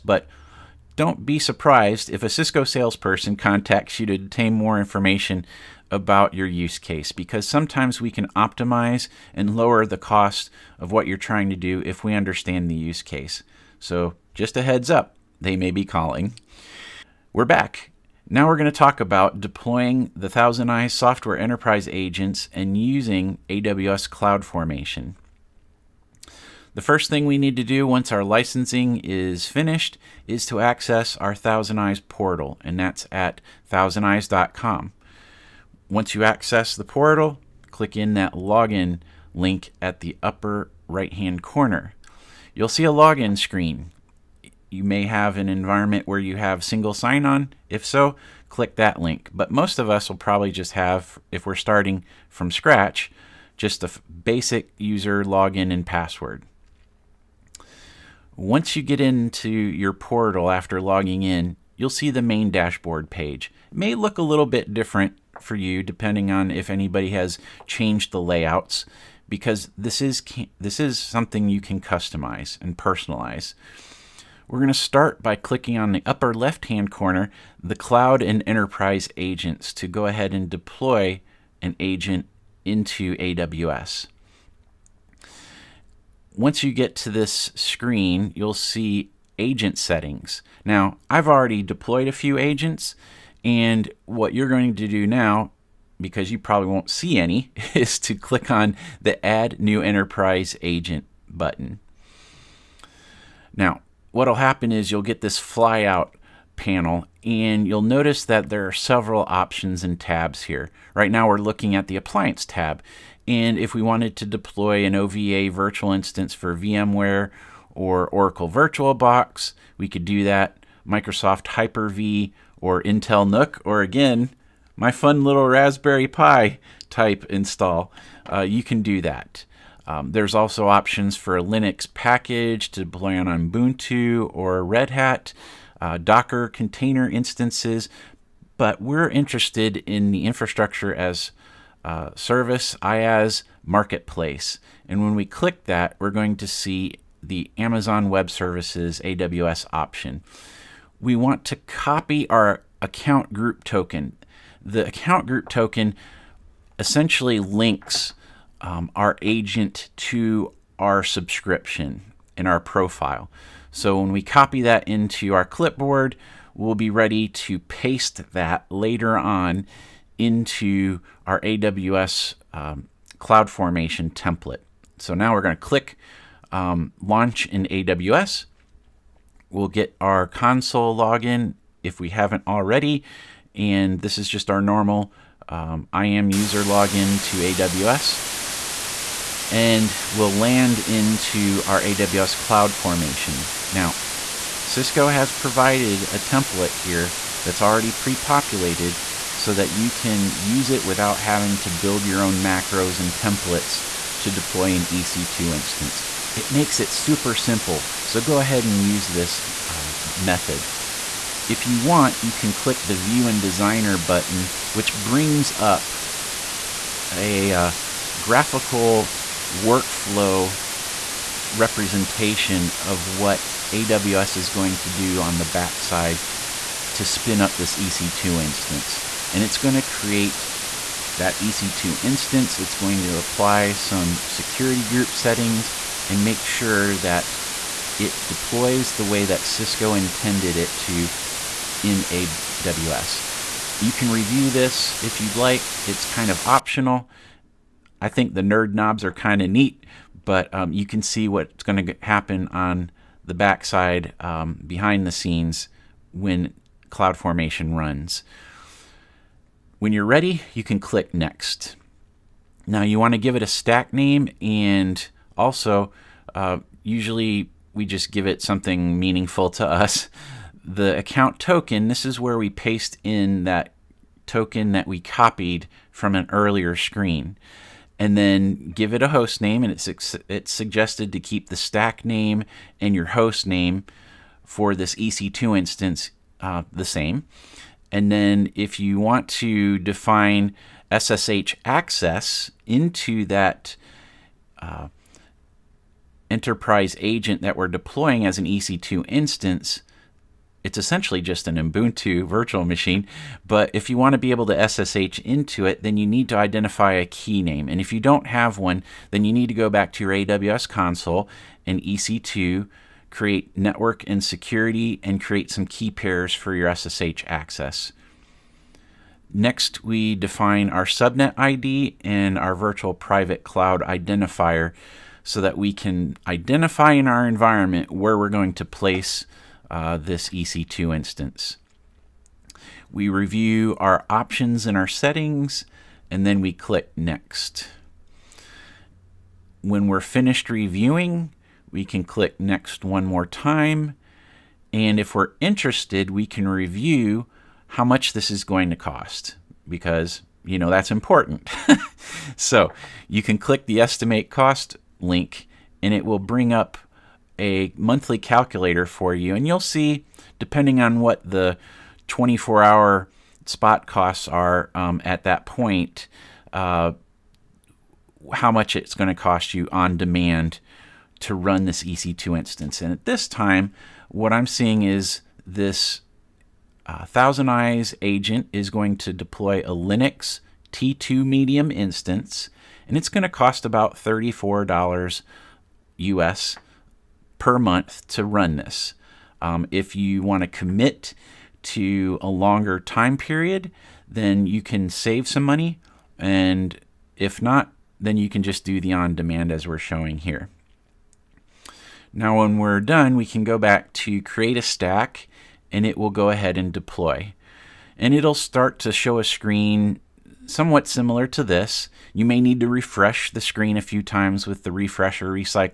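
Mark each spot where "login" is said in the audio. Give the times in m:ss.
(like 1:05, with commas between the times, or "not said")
0:38, 0:42, 0:55, 3:00, 3:06.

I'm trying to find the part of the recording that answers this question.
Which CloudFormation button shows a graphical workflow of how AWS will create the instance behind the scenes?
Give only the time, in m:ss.
3:32.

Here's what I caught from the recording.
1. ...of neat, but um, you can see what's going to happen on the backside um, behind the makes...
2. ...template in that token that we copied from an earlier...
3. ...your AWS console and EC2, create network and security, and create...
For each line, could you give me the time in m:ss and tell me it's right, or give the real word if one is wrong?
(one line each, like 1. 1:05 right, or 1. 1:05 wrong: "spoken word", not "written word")
1. 4:09 wrong: "scenes", not "makes"
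2. 4:32 wrong: "paste", not "template"
3. 5:10 right.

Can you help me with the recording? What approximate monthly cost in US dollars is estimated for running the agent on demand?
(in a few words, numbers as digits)
$34.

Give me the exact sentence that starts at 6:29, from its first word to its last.
Um, if you want to commit to a longer time period, then you can save some money.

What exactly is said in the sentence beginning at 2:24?
And when we click that, we're going to see the Amazon Web Services AWS option.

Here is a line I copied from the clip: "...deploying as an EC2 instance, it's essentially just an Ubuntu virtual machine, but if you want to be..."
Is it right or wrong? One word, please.
right.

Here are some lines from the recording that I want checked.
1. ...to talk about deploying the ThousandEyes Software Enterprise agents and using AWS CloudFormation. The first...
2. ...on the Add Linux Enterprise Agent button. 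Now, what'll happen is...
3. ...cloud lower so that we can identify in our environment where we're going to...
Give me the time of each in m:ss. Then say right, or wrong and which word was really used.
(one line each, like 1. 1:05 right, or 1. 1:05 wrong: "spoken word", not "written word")
1. 0:18 right
2. 1:38 wrong: "New", not "Linux"
3. 5:23 wrong: "identifier", not "lower".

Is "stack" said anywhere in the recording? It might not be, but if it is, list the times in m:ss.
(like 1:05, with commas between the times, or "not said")
4:23, 4:41, 6:44.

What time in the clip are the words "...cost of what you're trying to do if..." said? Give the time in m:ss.
0:09.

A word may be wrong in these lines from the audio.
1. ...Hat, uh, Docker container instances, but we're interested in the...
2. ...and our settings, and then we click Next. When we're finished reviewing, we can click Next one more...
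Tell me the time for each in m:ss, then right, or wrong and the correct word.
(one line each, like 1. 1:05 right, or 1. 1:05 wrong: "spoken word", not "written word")
1. 2:14 right
2. 5:34 right.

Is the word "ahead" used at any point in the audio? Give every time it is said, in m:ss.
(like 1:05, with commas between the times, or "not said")
1:20, 3:28, 6:46.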